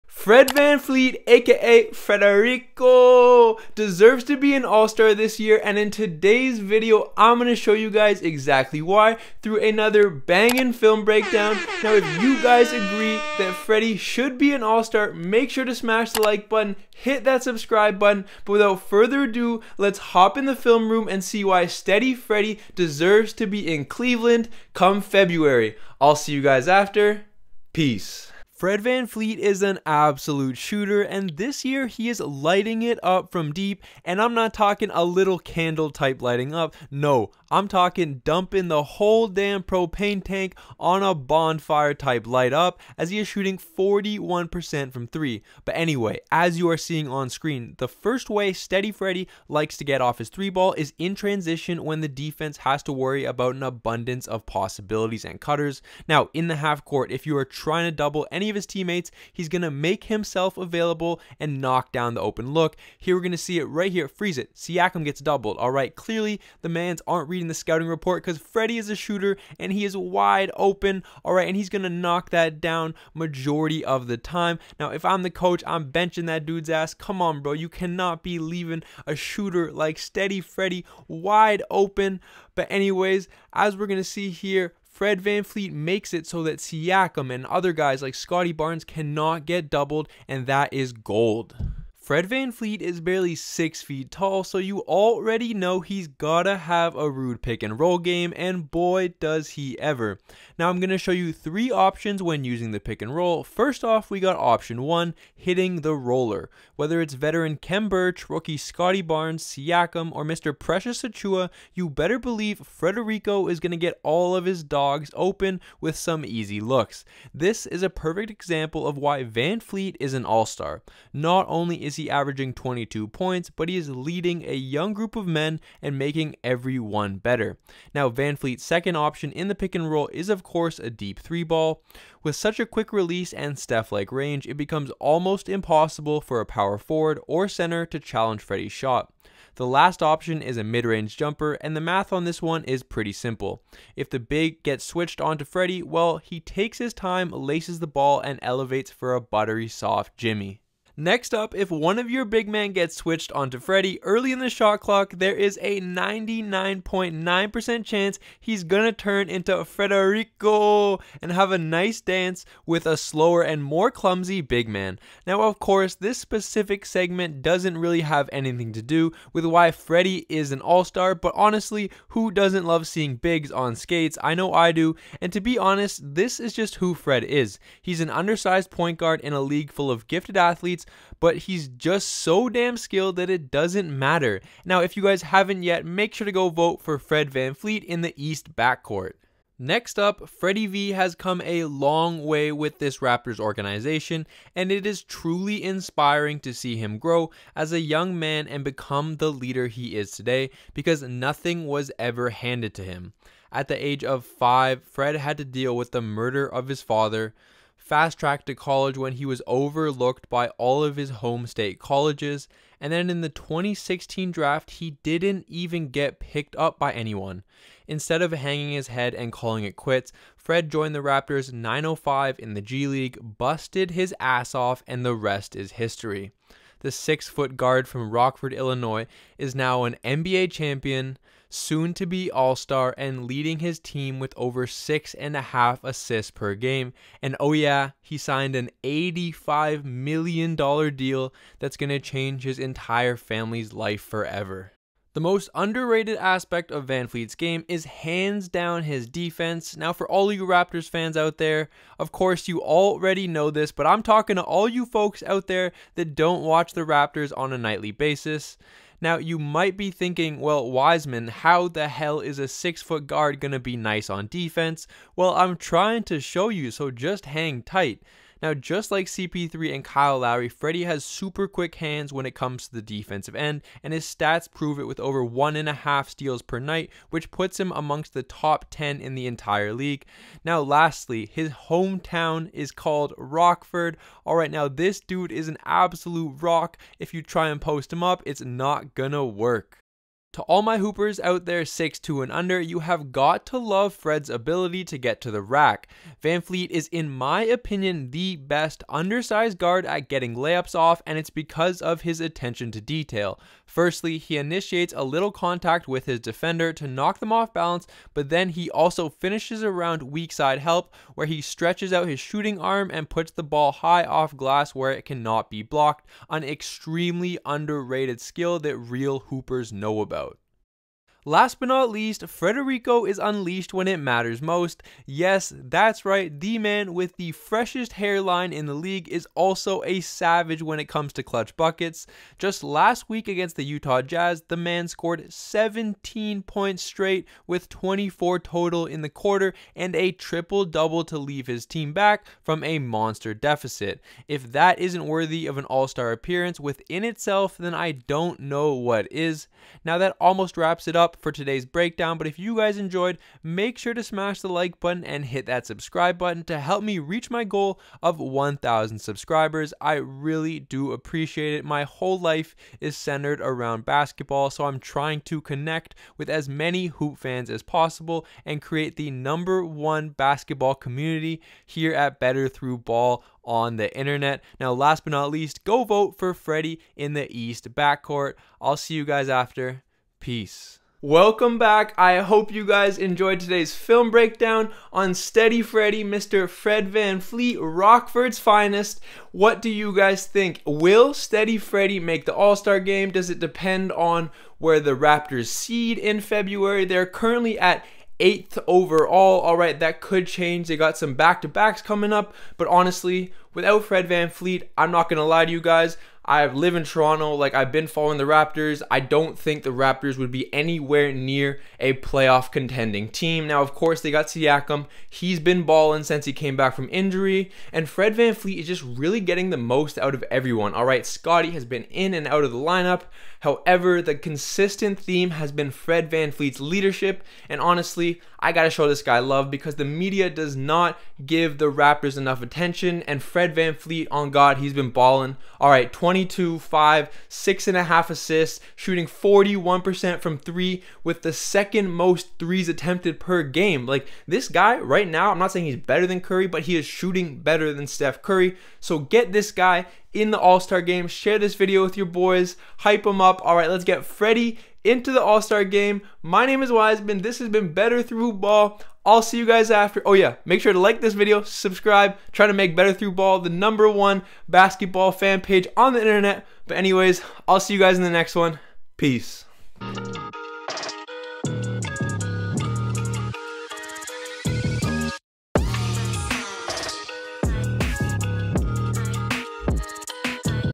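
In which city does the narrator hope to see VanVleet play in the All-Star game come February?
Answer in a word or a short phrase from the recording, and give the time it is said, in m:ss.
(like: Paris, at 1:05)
Cleveland, at 0:23.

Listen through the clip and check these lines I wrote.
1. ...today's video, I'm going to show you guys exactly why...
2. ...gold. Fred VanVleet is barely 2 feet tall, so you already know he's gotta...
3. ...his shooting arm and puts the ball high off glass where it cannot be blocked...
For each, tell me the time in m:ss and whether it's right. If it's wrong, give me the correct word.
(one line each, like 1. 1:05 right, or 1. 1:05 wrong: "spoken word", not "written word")
1. 0:05 right
2. 1:30 wrong: "6", not "2"
3. 5:12 right.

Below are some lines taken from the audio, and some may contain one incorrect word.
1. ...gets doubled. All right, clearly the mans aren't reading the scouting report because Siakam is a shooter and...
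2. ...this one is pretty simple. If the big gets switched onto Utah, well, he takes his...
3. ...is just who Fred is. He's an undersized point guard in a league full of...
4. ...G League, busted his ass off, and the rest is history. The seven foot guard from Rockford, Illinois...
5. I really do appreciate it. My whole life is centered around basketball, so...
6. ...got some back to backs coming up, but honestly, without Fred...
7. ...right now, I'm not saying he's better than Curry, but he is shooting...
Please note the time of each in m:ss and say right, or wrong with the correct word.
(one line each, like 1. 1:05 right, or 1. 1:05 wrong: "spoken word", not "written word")
1. 1:05 wrong: "Freddie", not "Siakam"
2. 2:22 wrong: "Freddie", not "Utah"
3. 2:56 right
4. 3:42 wrong: "six", not "seven"
5. 5:59 right
6. 6:40 right
7. 7:24 right.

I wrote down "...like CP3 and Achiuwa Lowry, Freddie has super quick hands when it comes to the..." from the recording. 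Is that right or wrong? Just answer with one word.
wrong.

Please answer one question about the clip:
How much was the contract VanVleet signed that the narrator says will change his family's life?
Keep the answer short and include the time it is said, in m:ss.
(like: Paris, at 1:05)
$85 million, at 3:58.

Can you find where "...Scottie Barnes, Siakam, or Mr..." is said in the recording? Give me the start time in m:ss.
1:48.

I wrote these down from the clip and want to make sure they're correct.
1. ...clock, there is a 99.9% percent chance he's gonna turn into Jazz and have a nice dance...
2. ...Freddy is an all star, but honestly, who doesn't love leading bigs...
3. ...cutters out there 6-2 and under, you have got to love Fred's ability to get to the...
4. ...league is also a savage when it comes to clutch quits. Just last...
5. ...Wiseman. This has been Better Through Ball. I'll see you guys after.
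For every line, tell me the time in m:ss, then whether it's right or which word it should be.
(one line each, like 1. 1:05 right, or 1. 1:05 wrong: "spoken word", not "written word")
1. 2:34 wrong: "Federico", not "Jazz"
2. 2:49 wrong: "seeing", not "leading"
3. 4:50 wrong: "hoopers", not "cutters"
4. 5:28 wrong: "buckets", not "quits"
5. 7:36 right.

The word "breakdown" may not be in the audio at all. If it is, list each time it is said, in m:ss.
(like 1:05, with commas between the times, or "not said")
0:11, 5:51, 6:24.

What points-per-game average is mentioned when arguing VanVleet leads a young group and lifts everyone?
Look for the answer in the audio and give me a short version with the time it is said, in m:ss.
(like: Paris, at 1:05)
22, at 2:02.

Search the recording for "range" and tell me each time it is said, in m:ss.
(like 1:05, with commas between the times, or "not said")
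2:14, 2:20.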